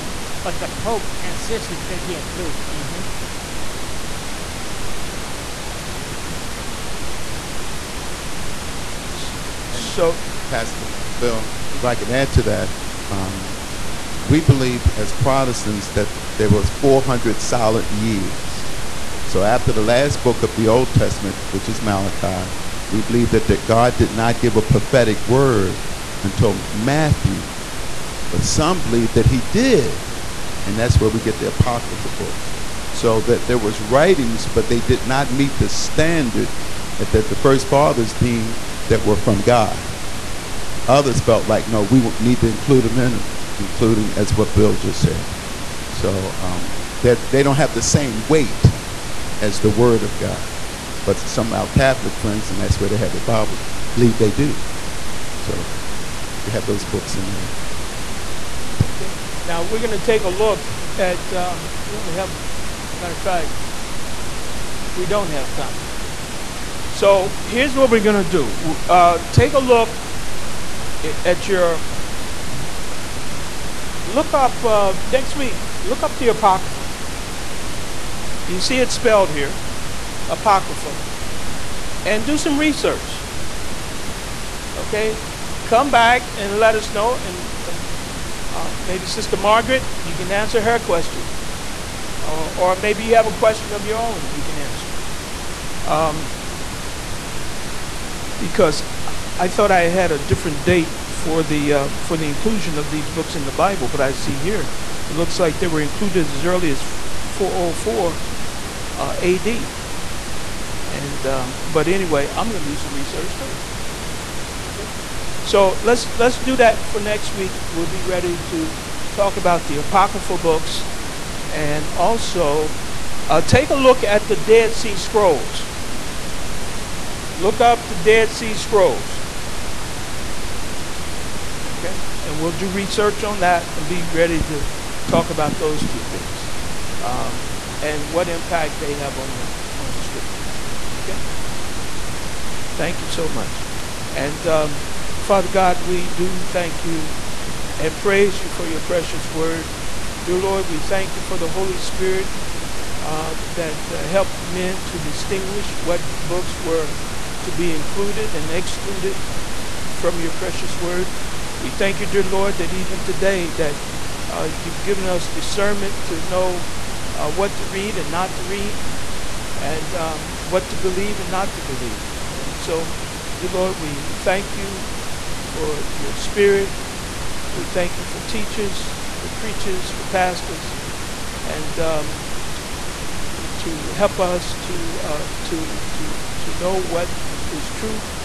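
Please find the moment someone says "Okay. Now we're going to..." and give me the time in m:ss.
0:58.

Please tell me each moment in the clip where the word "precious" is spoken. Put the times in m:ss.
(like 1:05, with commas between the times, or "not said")
2:28, 2:40.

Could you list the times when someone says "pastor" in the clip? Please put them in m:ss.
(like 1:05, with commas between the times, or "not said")
0:10, 3:00.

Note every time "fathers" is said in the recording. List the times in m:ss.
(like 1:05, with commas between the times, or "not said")
0:37, 2:25.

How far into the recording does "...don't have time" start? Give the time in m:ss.
1:05.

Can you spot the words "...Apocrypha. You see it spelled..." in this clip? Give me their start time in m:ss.
1:16.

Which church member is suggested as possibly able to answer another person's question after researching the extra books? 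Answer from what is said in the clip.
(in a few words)
Sister Margaret.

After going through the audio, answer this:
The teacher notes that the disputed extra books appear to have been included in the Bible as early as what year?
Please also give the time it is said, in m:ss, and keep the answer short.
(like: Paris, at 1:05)
404 AD, at 1:47.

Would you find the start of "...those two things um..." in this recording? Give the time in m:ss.
2:15.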